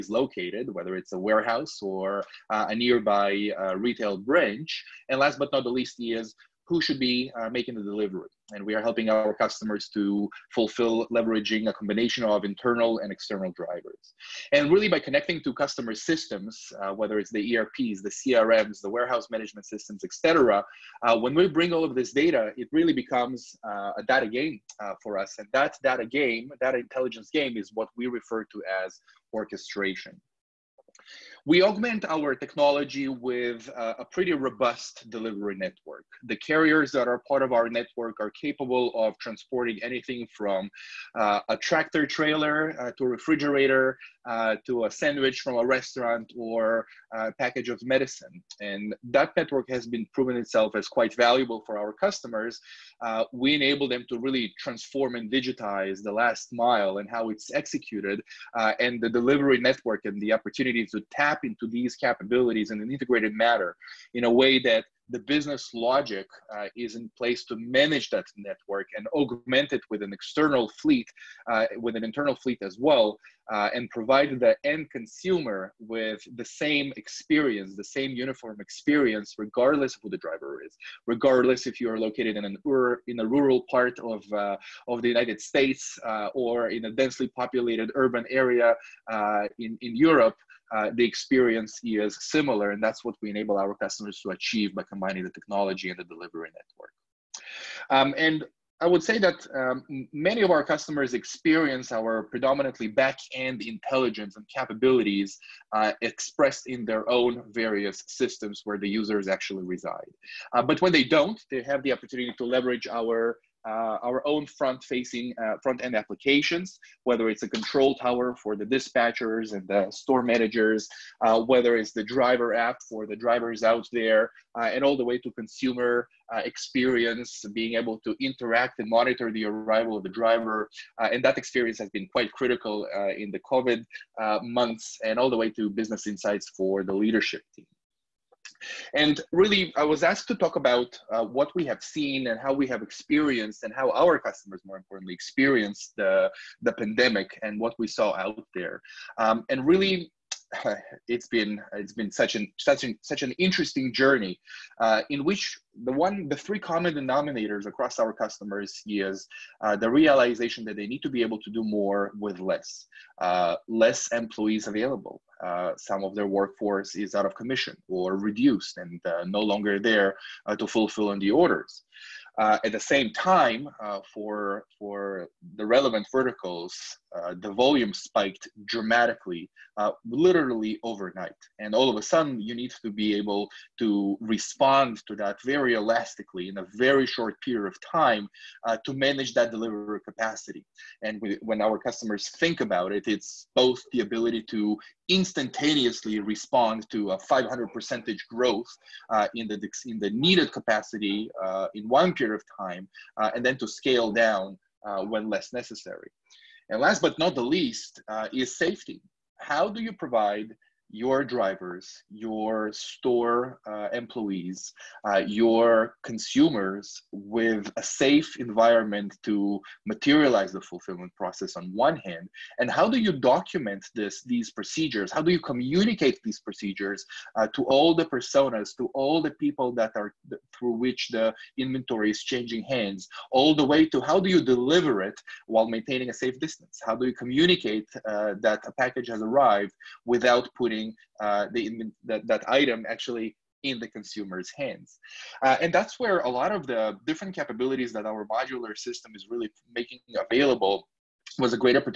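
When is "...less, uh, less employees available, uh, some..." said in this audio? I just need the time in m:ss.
2:42.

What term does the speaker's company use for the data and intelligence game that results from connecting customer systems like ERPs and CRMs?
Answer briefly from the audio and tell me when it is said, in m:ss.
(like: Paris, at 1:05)
Orchestration, at 0:29.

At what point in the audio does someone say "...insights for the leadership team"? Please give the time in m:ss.
2:16.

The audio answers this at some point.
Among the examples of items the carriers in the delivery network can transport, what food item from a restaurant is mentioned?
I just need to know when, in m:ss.
0:44.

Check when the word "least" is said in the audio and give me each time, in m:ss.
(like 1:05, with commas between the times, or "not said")
0:05, 3:27.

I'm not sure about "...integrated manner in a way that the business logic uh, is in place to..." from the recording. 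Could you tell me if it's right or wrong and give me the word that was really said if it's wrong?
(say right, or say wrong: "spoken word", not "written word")
right.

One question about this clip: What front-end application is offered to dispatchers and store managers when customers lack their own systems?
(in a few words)
Control tower.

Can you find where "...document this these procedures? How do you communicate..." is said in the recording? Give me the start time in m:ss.
3:43.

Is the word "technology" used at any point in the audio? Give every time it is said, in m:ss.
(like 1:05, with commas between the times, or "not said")
0:32, 1:35.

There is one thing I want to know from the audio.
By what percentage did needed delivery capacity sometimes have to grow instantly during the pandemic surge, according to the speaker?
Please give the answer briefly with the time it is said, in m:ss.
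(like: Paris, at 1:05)
500 percent, at 3:17.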